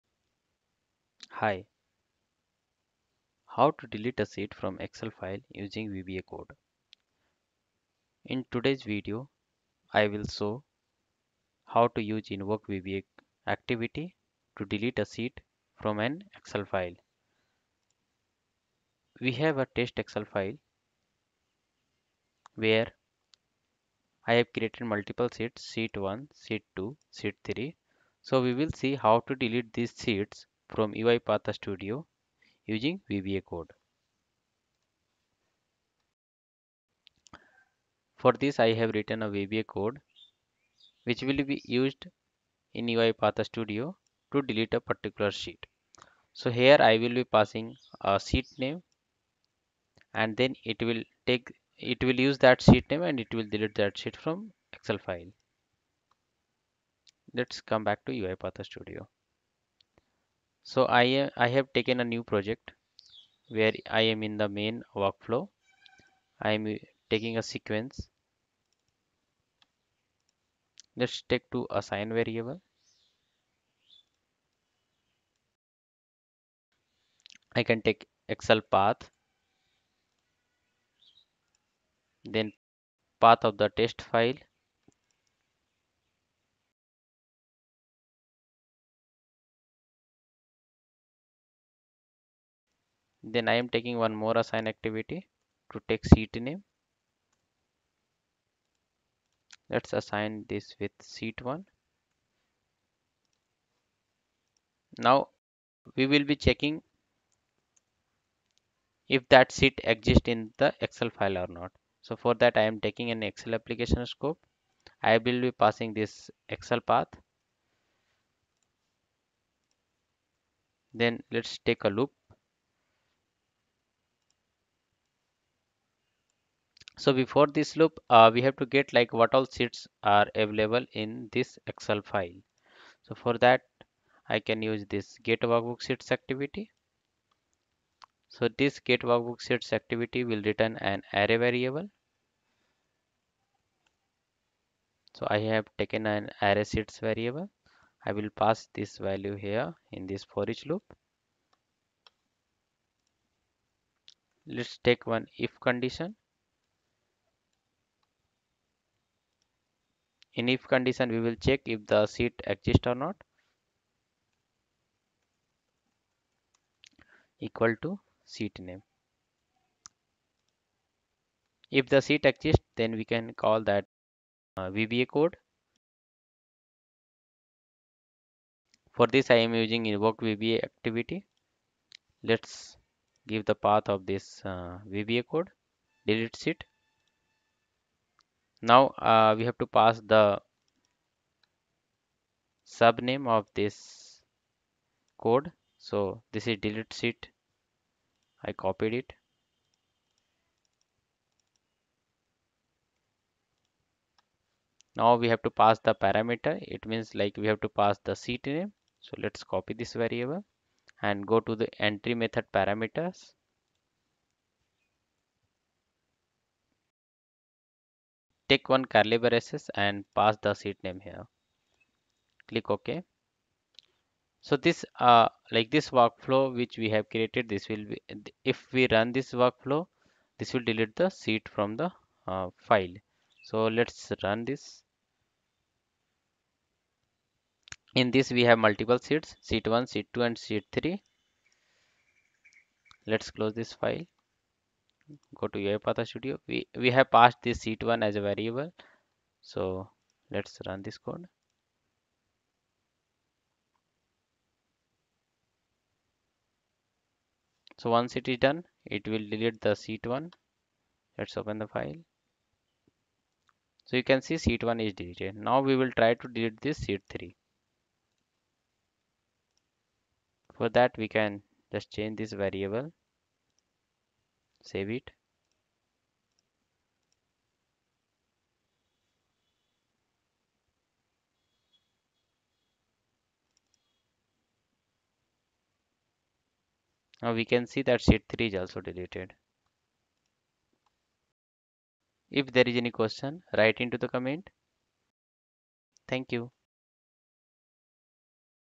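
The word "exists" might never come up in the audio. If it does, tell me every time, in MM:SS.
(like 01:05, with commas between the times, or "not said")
01:49, 02:42, 02:52.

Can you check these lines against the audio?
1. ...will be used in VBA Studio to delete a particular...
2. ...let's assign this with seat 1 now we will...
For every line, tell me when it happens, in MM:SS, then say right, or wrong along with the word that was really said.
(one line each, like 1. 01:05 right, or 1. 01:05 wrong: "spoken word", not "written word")
1. 00:41 wrong: "UiPath", not "VBA"
2. 01:39 right.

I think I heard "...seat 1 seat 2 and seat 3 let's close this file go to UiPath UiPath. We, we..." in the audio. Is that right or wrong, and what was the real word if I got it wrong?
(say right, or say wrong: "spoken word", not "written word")
wrong: "Studio", not "UiPath".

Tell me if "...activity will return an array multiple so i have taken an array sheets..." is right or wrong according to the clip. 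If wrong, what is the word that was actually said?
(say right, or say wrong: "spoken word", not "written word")
wrong: "variable", not "multiple".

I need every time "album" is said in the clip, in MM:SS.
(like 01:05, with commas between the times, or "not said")
not said.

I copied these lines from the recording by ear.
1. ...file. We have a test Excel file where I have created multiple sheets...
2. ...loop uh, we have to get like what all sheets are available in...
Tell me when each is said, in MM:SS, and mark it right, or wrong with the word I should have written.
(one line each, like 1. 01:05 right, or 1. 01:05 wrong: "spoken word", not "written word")
1. 00:16 right
2. 02:07 right.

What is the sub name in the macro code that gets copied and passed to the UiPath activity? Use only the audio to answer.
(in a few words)
delete sheet.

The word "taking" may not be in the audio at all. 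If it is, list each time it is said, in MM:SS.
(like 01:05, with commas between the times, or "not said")
01:07, 01:33, 01:52.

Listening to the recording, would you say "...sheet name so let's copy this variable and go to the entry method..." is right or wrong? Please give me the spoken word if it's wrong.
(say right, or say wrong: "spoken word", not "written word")
right.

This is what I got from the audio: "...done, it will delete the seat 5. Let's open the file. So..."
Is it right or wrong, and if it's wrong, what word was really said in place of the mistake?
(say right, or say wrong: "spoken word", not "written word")
wrong: "1", not "5".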